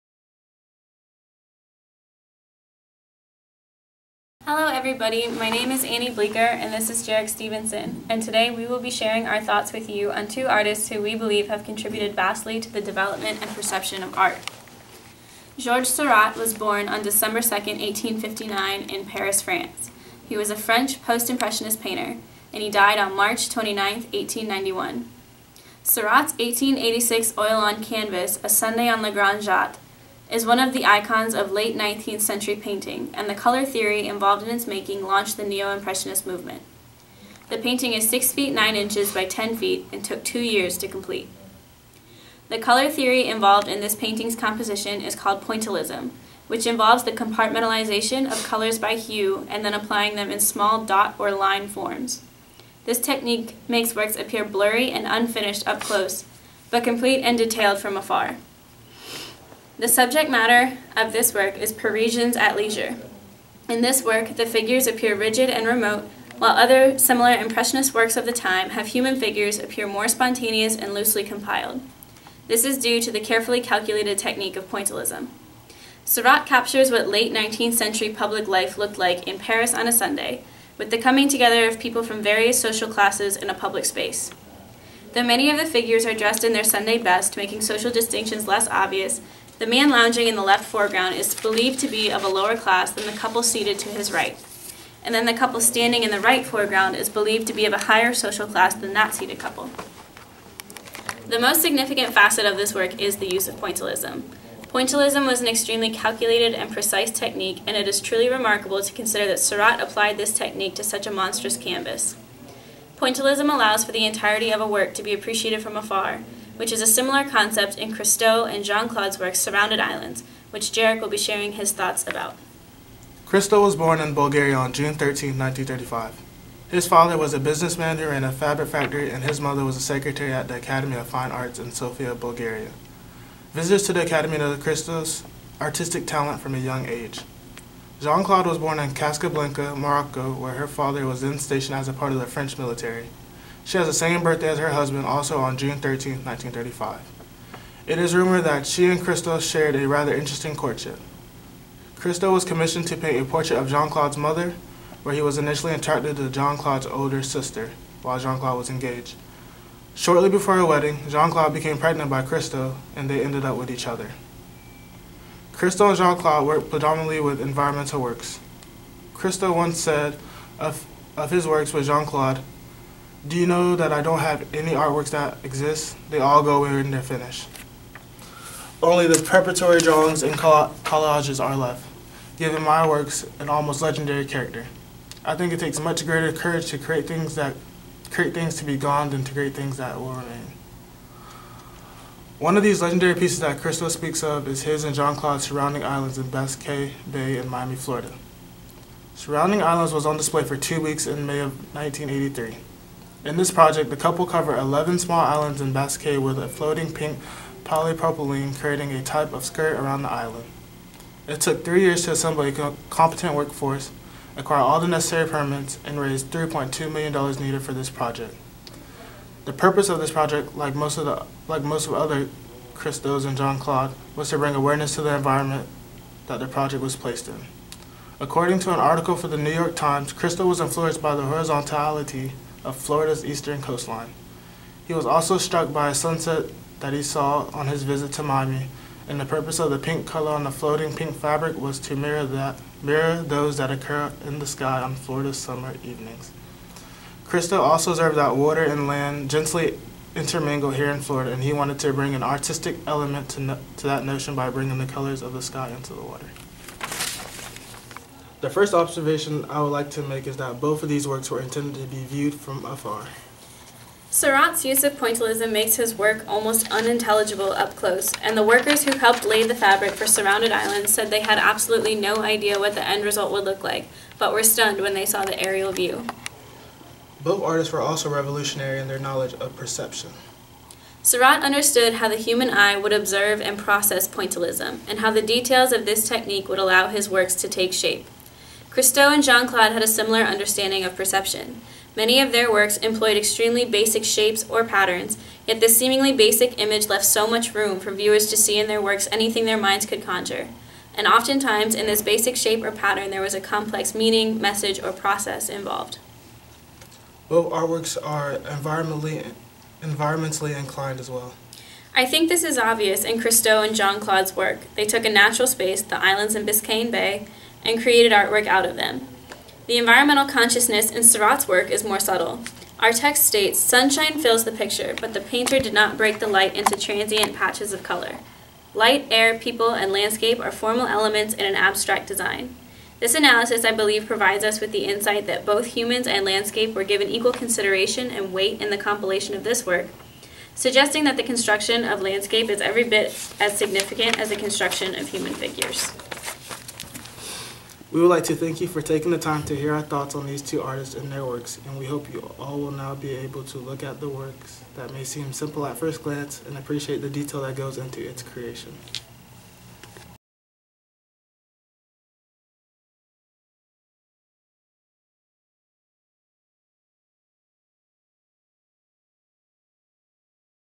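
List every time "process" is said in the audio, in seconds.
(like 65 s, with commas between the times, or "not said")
283 s, 304 s.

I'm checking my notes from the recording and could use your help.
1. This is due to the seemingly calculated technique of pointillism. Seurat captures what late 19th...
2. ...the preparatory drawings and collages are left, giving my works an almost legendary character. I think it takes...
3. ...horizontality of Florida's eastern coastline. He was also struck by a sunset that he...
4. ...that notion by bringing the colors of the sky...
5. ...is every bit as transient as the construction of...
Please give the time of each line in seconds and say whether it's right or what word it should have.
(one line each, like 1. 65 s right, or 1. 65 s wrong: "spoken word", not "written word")
1. 72 s wrong: "carefully", not "seemingly"
2. 179 s right
3. 231 s right
4. 253 s right
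5. 342 s wrong: "significant", not "transient".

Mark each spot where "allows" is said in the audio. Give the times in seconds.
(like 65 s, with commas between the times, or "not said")
113 s, 286 s.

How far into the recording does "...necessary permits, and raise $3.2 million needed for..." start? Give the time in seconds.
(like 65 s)
214 s.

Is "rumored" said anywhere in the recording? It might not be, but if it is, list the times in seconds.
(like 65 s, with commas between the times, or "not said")
148 s.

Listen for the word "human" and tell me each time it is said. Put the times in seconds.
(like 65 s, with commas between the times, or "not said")
68 s, 282 s, 335 s, 345 s.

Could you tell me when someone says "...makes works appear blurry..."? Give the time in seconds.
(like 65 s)
53 s.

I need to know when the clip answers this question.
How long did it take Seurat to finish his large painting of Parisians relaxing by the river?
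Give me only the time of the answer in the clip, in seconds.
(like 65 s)
40 s.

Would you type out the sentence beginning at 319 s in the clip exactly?
The environmental consciousness in Seurat's work is more subtle.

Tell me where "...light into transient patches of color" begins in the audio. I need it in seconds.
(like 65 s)
326 s.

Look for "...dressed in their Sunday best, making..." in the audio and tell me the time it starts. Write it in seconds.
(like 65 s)
86 s.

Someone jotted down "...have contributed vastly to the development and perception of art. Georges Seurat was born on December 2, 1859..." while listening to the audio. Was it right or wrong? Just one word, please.
right.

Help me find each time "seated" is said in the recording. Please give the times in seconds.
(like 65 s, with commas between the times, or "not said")
93 s, 99 s.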